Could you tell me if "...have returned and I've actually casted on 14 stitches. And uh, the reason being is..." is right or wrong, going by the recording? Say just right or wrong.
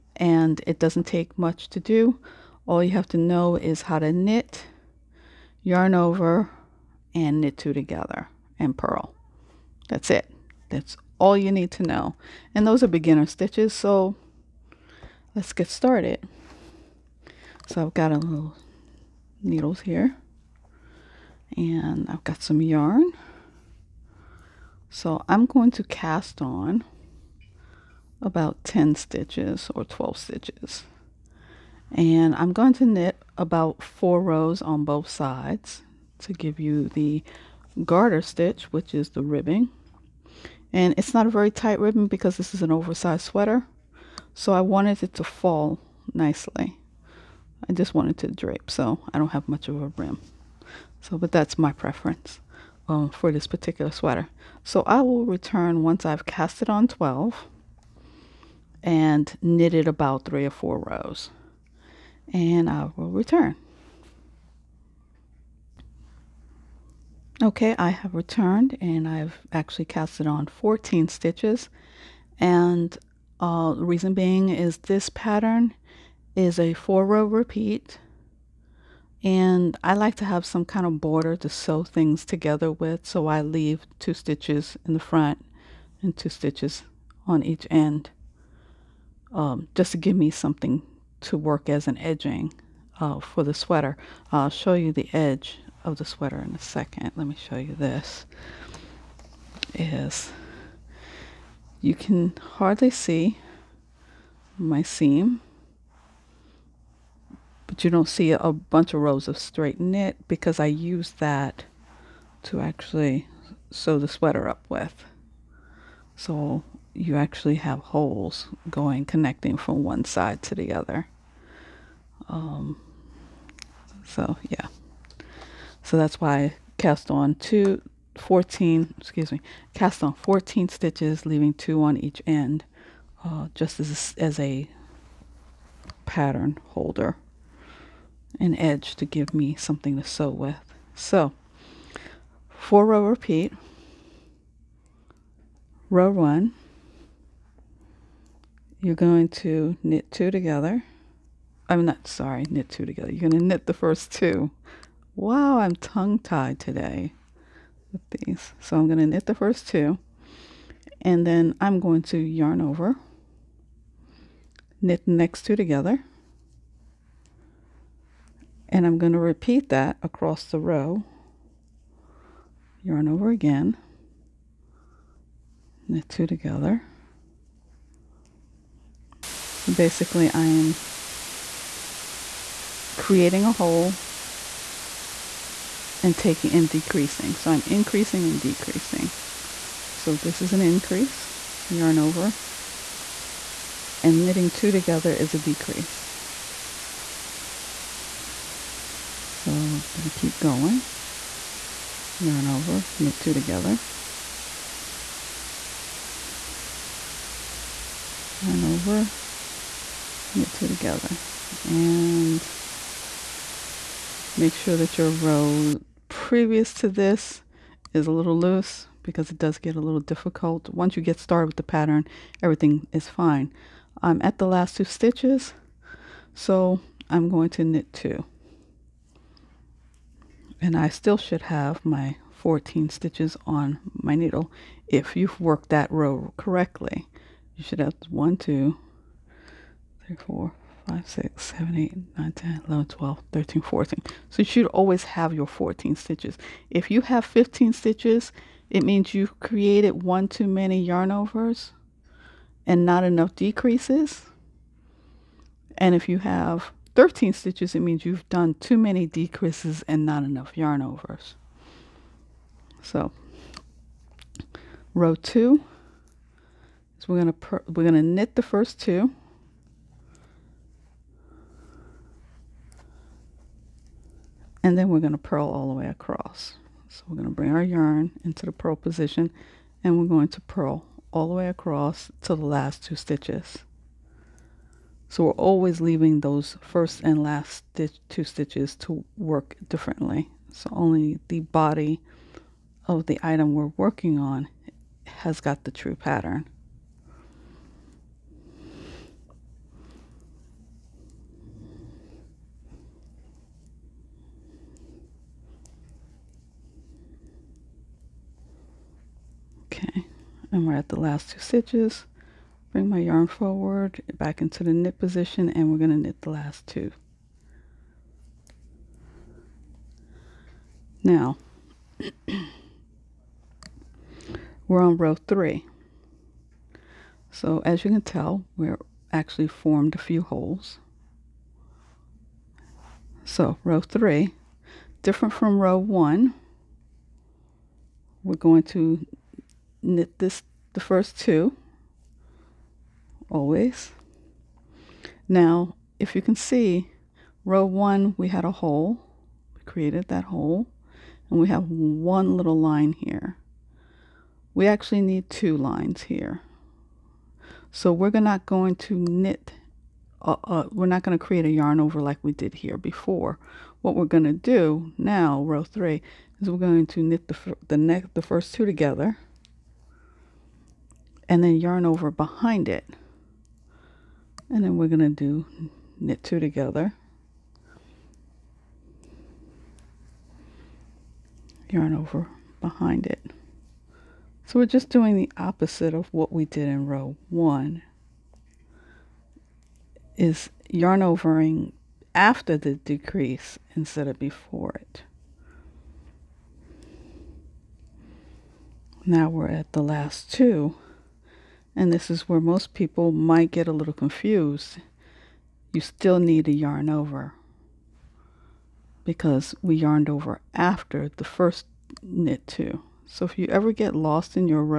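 right.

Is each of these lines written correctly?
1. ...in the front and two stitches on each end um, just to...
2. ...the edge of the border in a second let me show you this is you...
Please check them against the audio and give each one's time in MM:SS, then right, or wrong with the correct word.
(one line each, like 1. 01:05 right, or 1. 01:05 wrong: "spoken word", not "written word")
1. 01:24 right
2. 01:34 wrong: "sweater", not "border".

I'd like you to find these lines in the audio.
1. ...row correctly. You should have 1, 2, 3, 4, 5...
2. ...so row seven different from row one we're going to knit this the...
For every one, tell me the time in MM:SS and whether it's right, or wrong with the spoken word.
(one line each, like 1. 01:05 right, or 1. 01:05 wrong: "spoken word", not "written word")
1. 03:55 right
2. 05:33 wrong: "three", not "seven".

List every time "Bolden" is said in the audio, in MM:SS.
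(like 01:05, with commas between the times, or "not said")
not said.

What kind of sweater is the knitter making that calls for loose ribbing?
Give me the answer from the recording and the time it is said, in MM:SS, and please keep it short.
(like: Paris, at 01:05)
Oversized sweater, at 00:42.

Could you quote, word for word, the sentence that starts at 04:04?
So you should always have your 14 stitches.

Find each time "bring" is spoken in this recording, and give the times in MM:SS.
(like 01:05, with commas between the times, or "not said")
04:37, 05:12.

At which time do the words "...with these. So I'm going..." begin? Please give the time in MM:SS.
02:37.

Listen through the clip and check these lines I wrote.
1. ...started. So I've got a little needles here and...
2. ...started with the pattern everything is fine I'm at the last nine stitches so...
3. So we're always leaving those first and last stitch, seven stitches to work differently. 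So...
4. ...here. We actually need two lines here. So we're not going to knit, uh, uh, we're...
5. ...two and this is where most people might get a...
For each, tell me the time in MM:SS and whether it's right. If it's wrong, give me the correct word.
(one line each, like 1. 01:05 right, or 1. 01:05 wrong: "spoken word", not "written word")
1. 00:15 right
2. 03:41 wrong: "two", not "nine"
3. 04:45 wrong: "two", not "seven"
4. 05:52 right
5. 06:40 right.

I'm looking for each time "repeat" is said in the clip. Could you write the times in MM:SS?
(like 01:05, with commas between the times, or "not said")
01:17, 02:23, 02:49.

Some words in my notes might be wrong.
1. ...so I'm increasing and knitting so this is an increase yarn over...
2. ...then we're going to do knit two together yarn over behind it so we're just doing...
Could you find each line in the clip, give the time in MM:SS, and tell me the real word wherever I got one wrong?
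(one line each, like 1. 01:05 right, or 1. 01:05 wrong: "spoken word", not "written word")
1. 03:07 wrong: "decreasing", not "knitting"
2. 06:14 right.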